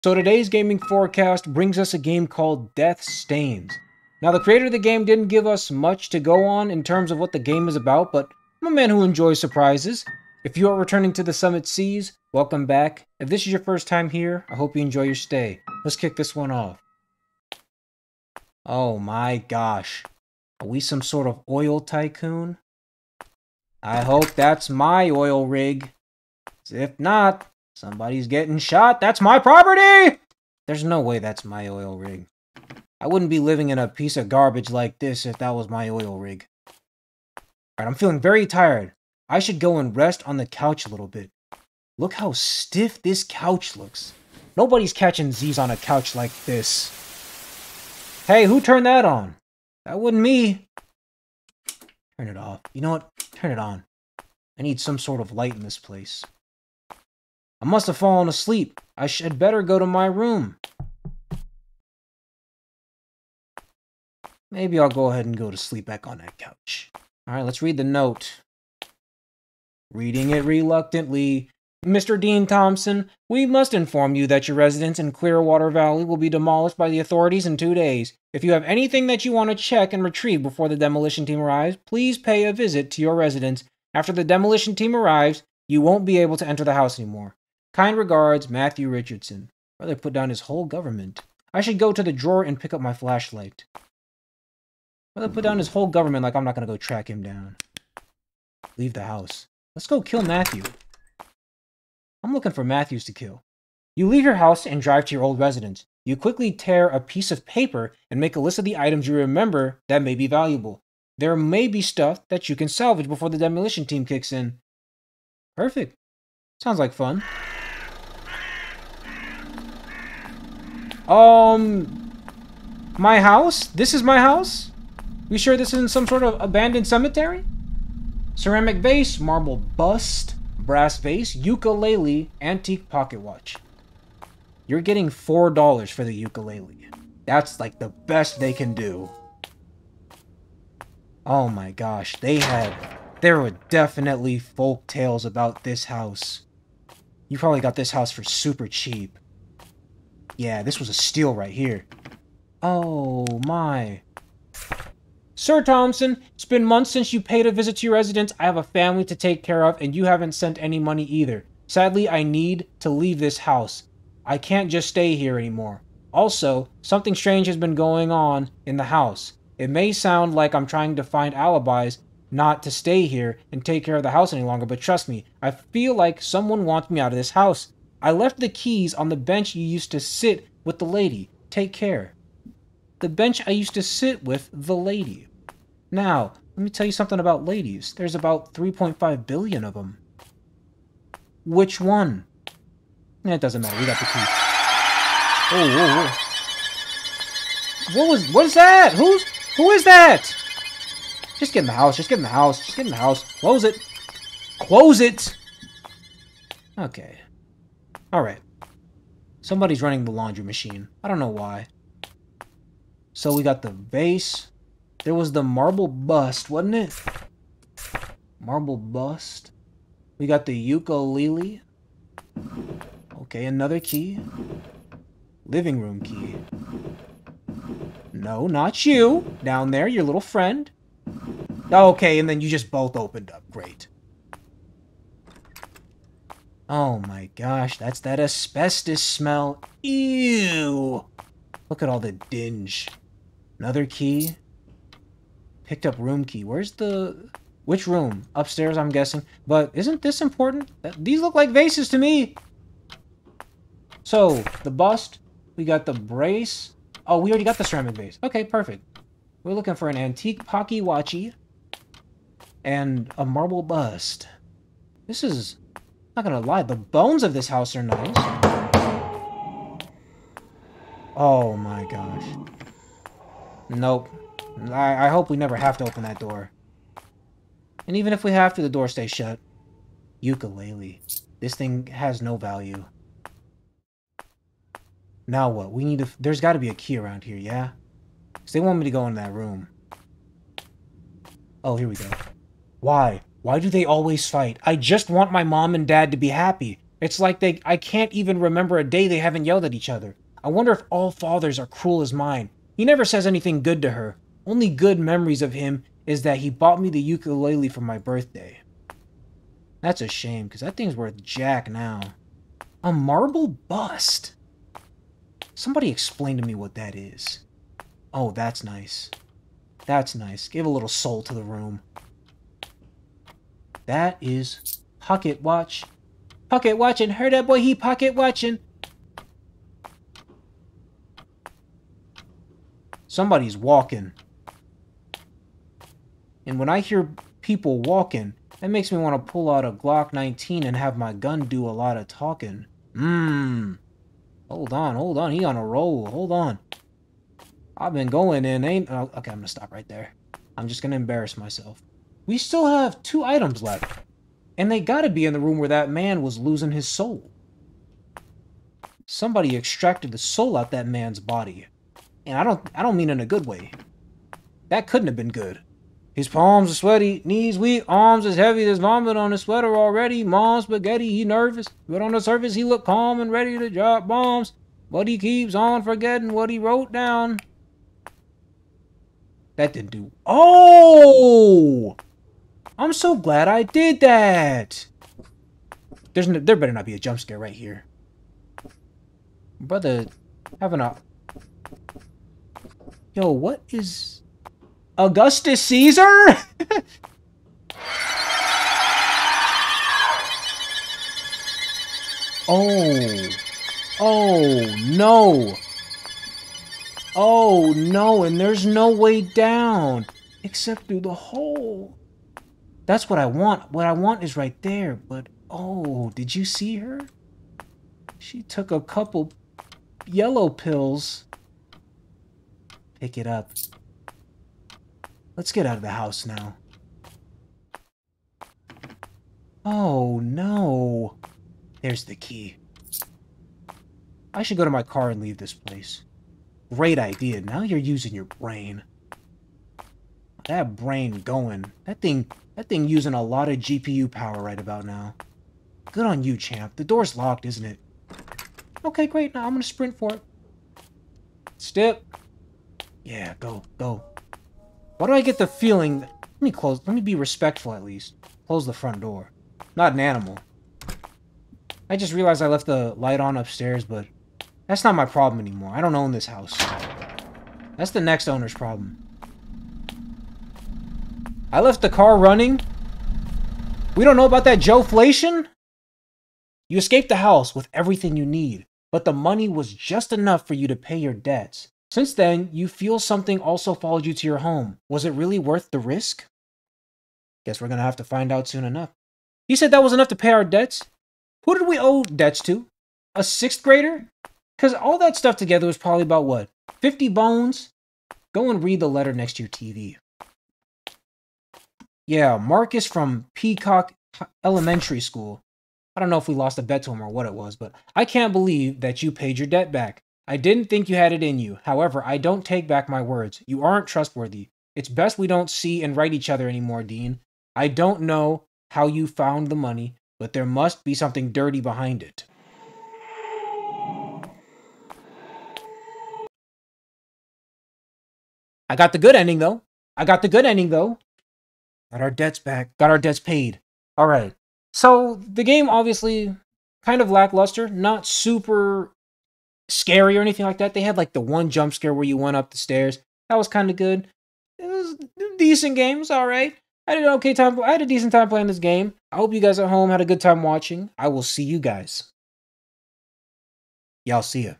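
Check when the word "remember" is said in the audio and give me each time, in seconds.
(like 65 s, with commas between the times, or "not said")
109 s, 298 s.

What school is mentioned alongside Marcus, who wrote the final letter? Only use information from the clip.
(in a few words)
Peacock Elementary School.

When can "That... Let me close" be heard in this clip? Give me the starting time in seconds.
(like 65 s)
456 s.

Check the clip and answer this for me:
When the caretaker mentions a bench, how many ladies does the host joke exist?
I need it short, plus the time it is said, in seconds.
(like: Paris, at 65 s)
3.5 billion, at 188 s.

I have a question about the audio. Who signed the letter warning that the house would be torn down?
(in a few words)
Matthew Richardson.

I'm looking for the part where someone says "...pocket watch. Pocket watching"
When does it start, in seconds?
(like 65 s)
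324 s.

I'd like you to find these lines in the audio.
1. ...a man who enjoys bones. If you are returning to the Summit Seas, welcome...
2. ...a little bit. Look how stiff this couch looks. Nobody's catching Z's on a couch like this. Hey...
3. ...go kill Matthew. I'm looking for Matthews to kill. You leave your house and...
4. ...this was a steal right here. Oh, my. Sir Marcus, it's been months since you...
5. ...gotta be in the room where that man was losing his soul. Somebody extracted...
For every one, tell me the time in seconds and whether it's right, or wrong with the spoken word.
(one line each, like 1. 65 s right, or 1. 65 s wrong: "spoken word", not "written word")
1. 8 s wrong: "surprises", not "bones"
2. 40 s right
3. 99 s right
4. 150 s wrong: "Thompson", not "Marcus"
5. 354 s right.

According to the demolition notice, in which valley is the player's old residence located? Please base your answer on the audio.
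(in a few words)
Clearwater Valley.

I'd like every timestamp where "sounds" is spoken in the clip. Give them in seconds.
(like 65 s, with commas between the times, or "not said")
116 s, 169 s.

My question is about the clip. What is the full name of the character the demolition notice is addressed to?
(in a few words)
Dean Thompson.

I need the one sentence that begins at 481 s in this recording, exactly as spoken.
Since then, you feel something also followed you to your home.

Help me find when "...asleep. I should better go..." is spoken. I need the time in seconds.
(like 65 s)
58 s.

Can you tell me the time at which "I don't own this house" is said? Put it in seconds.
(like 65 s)
465 s.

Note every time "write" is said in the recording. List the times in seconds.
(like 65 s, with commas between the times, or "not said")
515 s.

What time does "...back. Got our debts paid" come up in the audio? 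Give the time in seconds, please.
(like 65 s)
532 s.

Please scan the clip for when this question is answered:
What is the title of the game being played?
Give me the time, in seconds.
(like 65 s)
2 s.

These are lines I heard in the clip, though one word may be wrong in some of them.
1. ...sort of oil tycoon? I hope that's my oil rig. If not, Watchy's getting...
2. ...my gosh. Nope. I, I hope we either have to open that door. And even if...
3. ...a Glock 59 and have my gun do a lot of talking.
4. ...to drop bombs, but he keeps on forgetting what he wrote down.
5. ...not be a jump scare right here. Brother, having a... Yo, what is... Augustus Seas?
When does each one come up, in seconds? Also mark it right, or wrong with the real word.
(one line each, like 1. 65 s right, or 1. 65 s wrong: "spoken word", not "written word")
1. 21 s wrong: "Somebody", not "Watchy"
2. 271 s wrong: "never", not "either"
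3. 339 s wrong: "19", not "59"
4. 373 s right
5. 386 s wrong: "Caesar", not "Seas".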